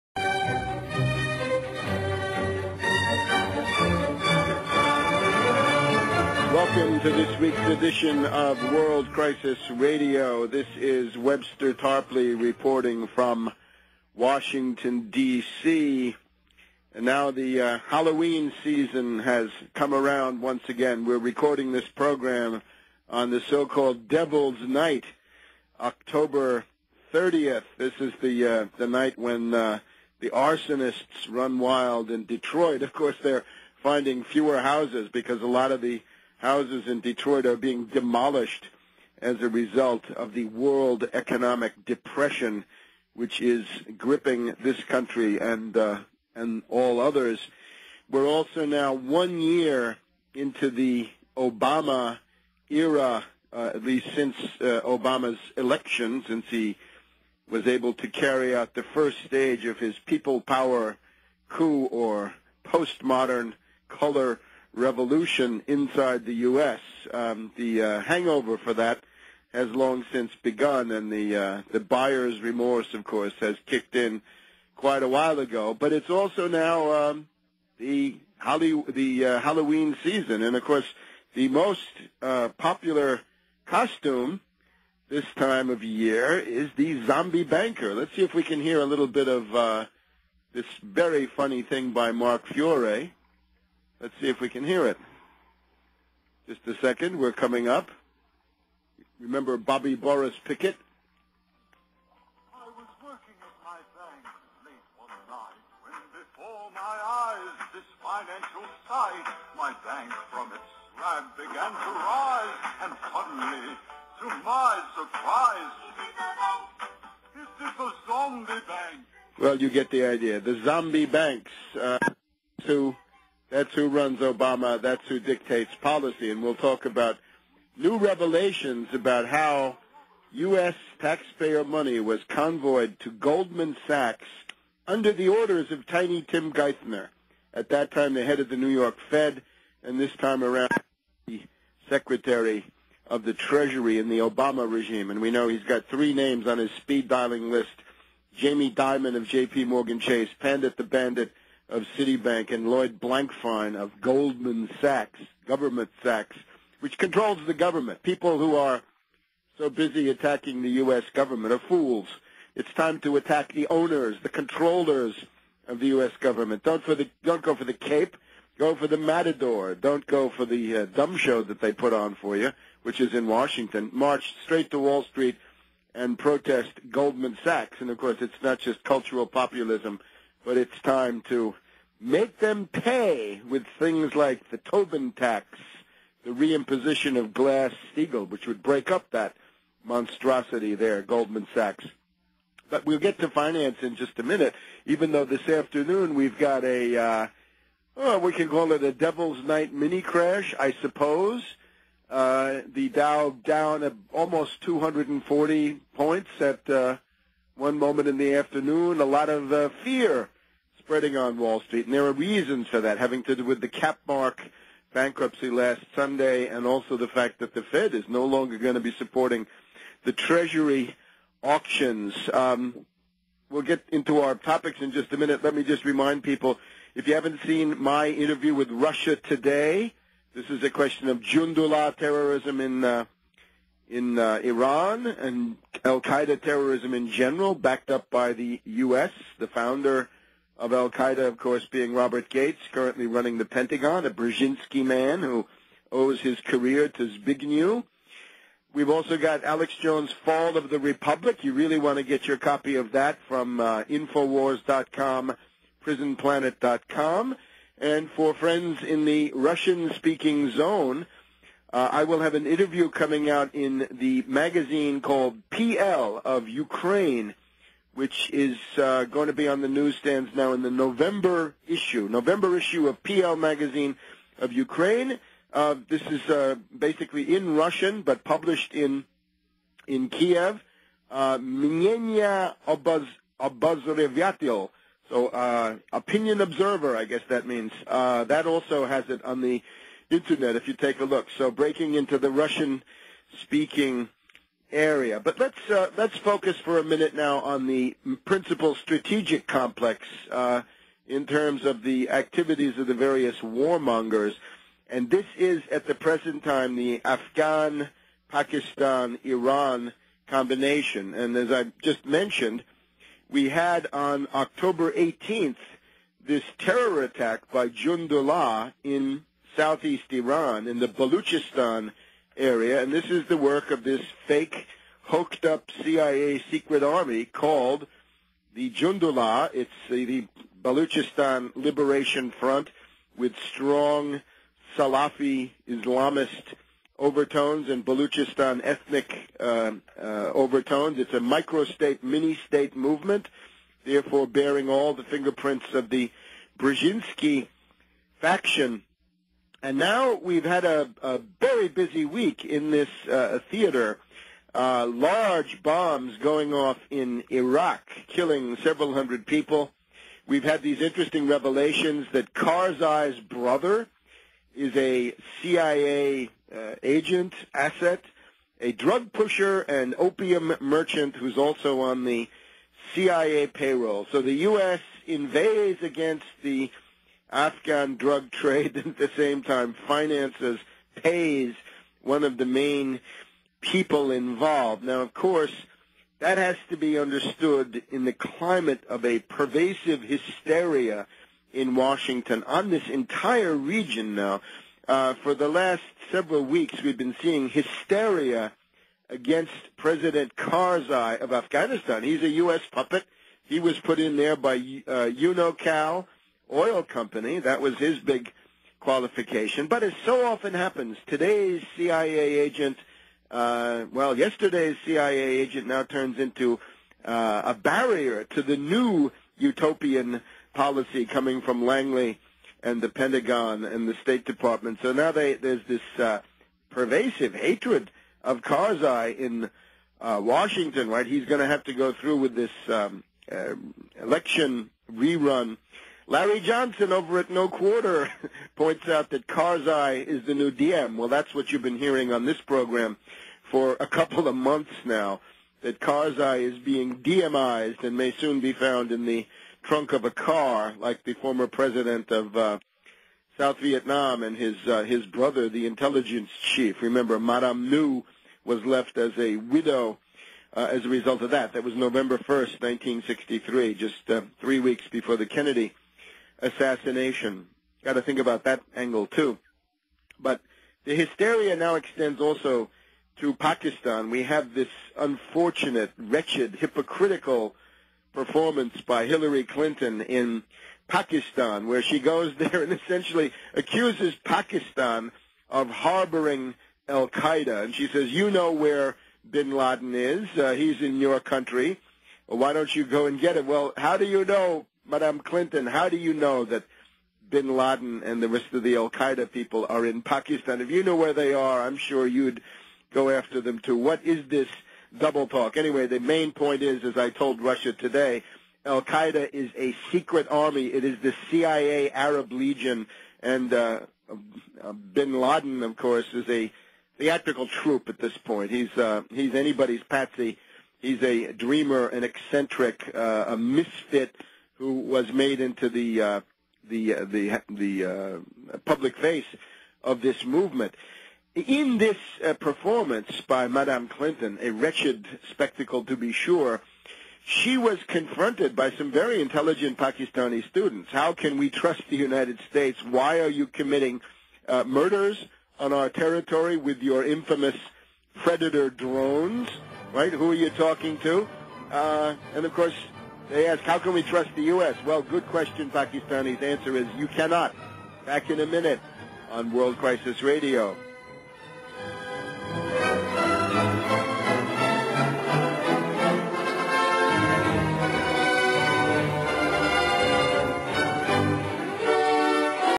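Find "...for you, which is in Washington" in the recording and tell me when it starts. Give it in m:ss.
2:52.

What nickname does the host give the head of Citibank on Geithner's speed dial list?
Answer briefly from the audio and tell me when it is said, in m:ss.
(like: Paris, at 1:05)
Pandit the Bandit, at 2:30.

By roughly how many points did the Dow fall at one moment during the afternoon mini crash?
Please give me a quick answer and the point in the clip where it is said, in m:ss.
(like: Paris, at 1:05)
240, at 3:24.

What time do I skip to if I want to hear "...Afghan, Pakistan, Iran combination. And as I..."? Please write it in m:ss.
5:07.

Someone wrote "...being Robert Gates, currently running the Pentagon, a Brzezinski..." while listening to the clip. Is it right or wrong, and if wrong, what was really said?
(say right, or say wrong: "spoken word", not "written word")
right.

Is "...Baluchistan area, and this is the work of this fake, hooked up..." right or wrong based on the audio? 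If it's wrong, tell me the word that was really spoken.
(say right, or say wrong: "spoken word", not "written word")
right.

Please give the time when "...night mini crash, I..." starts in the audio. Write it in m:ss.
3:19.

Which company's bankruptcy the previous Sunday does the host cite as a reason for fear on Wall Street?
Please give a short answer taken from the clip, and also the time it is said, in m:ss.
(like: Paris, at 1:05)
Capmark, at 3:33.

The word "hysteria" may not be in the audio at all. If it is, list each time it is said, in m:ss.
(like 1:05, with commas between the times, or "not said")
6:30, 6:37, 7:50.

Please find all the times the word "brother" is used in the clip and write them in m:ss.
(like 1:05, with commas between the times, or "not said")
6:03, 7:35.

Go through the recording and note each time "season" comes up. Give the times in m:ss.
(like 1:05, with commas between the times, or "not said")
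0:18, 1:20.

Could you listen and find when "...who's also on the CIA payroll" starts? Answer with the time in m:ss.
6:11.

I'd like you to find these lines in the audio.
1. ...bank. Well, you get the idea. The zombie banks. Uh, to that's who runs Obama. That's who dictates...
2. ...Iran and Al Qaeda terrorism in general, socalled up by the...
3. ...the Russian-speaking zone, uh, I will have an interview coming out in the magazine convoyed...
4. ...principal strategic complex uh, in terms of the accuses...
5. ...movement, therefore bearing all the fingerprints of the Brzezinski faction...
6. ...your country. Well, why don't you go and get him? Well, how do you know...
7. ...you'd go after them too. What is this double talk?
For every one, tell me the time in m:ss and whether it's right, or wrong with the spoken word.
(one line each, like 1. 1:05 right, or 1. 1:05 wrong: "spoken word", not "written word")
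1. 1:58 right
2. 3:54 wrong: "backed", not "socalled"
3. 4:19 wrong: "called", not "convoyed"
4. 4:58 wrong: "activities", not "accuses"
5. 5:42 right
6. 8:10 right
7. 8:22 right.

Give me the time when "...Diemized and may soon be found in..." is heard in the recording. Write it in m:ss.
7:26.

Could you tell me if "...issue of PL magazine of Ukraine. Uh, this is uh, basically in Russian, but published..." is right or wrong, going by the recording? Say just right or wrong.
right.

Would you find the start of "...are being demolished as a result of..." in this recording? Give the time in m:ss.
0:37.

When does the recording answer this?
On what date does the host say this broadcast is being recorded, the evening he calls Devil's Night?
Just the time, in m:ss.
0:25.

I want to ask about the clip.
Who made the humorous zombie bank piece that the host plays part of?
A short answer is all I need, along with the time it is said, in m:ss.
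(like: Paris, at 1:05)
Mark Fiore, at 1:32.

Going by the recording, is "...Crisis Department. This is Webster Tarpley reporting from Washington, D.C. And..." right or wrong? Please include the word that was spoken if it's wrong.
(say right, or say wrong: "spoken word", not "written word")
wrong: "Radio", not "Department".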